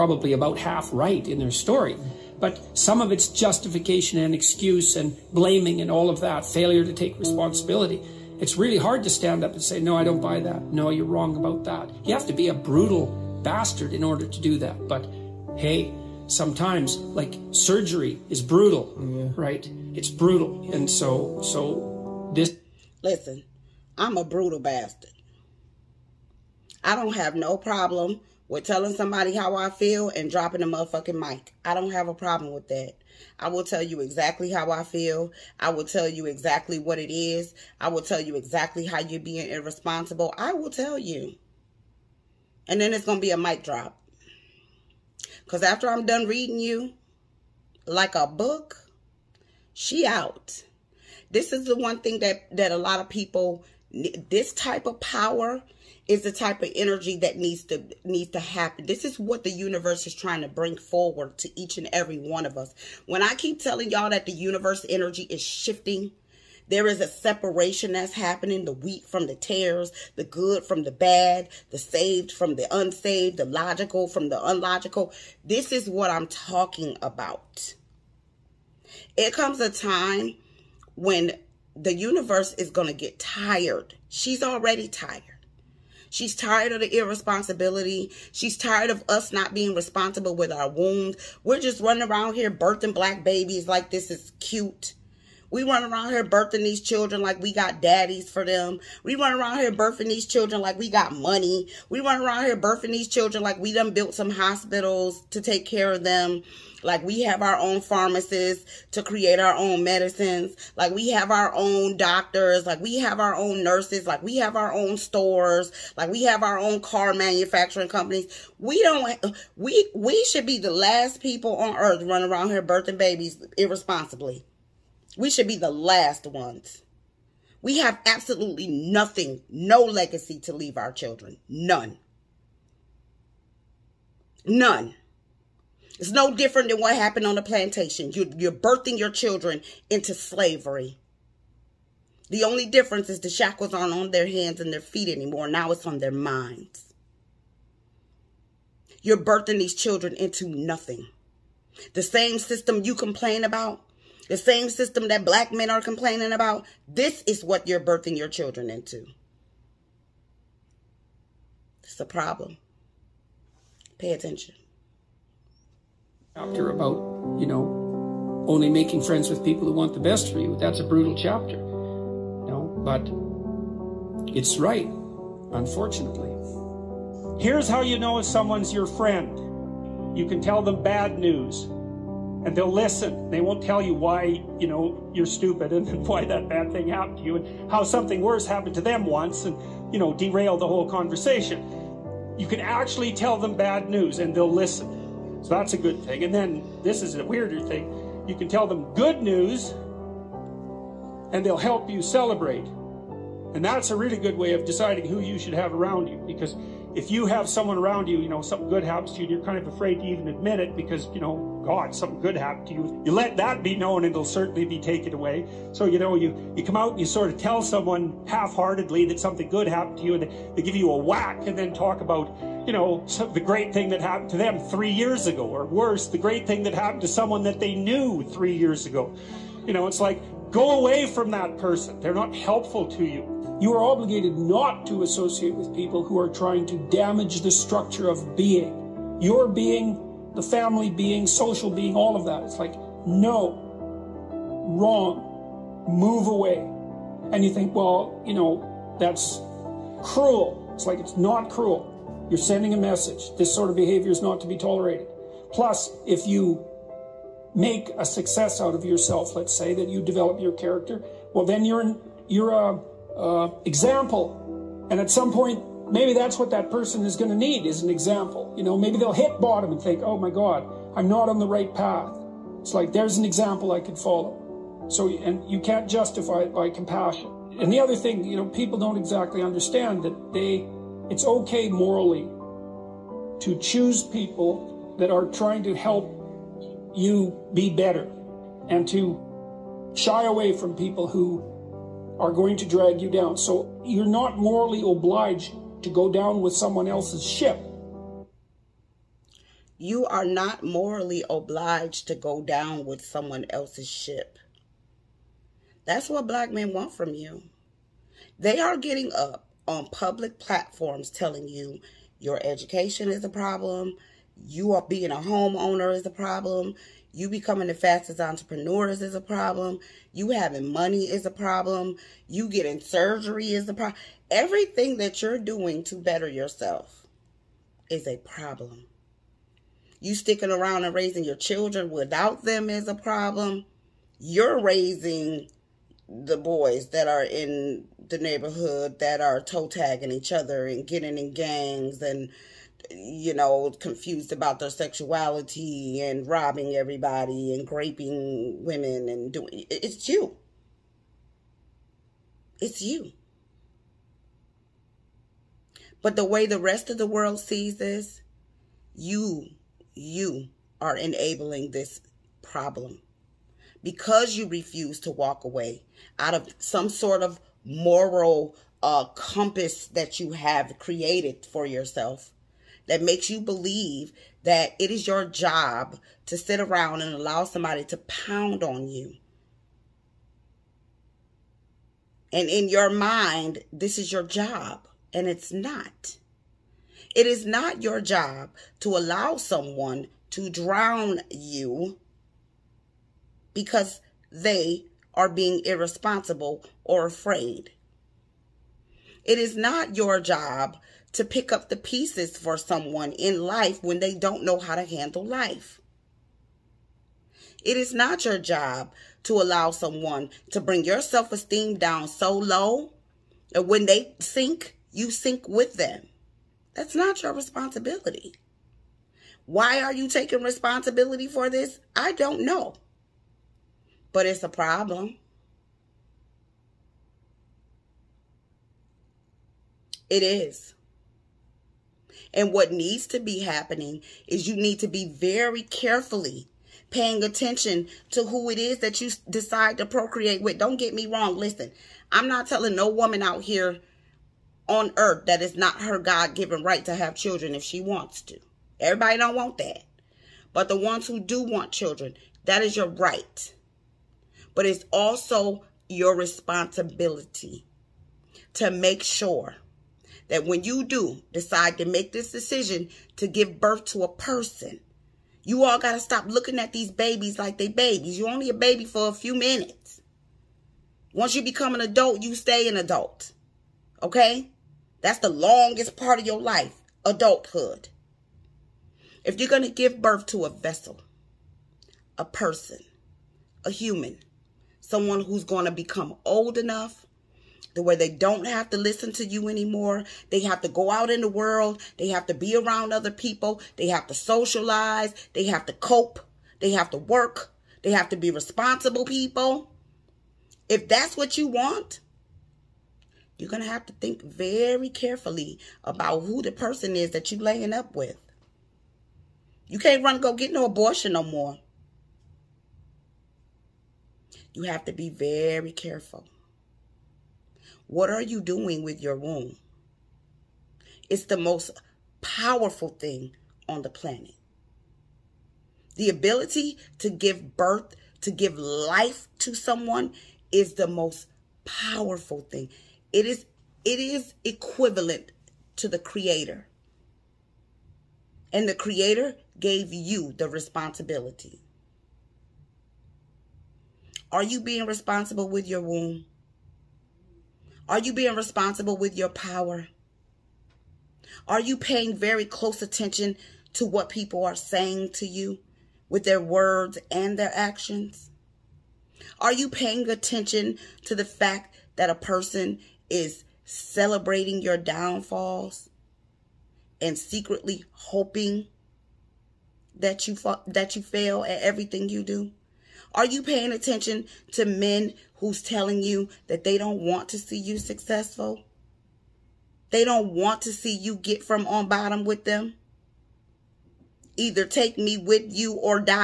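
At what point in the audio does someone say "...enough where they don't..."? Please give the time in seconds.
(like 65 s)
486 s.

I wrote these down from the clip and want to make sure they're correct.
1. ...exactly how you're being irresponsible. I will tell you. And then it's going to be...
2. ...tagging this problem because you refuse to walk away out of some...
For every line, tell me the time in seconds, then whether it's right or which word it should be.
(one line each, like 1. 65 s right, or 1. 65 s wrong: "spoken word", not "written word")
1. 38 s right
2. 360 s wrong: "enabling", not "tagging".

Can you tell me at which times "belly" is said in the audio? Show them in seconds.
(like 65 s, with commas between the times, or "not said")
not said.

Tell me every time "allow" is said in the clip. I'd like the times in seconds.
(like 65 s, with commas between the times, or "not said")
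377 s, 388 s, 409 s.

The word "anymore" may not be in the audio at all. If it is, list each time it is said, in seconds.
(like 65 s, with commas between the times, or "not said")
145 s, 489 s.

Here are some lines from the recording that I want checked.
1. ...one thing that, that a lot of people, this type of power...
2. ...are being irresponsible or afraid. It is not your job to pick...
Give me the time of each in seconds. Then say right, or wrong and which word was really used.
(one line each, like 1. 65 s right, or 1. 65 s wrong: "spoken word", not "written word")
1. 51 s right
2. 395 s right.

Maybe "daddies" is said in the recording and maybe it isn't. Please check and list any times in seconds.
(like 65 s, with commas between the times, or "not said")
97 s.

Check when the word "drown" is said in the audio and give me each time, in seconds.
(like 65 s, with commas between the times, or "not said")
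390 s.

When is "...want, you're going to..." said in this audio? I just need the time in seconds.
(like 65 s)
501 s.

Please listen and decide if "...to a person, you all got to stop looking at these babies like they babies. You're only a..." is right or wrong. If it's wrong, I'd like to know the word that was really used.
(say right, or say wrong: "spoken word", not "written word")
right.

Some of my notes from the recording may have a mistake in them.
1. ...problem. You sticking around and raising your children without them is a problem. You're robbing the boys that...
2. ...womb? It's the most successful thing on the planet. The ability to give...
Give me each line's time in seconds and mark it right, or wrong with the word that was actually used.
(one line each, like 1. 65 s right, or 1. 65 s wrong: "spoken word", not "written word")
1. 328 s wrong: "raising", not "robbing"
2. 519 s wrong: "powerful", not "successful".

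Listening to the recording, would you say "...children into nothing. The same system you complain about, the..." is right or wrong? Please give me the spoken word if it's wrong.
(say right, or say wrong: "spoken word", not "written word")
right.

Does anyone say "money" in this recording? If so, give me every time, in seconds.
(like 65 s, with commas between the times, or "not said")
101 s, 320 s.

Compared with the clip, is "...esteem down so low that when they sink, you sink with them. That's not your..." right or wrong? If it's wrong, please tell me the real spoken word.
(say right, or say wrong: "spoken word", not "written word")
right.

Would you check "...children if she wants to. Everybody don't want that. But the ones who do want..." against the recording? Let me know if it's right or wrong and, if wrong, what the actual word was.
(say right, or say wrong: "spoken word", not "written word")
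right.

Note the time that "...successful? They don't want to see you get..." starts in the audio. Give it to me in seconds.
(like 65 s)
577 s.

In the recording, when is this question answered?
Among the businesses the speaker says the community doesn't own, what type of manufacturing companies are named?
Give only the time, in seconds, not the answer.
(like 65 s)
116 s.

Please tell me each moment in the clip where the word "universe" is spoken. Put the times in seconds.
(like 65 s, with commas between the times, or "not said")
59 s, 64 s, 81 s.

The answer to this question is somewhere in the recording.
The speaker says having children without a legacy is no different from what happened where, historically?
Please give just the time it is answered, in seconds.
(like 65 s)
137 s.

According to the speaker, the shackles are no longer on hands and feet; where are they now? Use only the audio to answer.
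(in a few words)
on their minds.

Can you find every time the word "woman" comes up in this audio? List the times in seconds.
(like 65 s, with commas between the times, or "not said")
442 s.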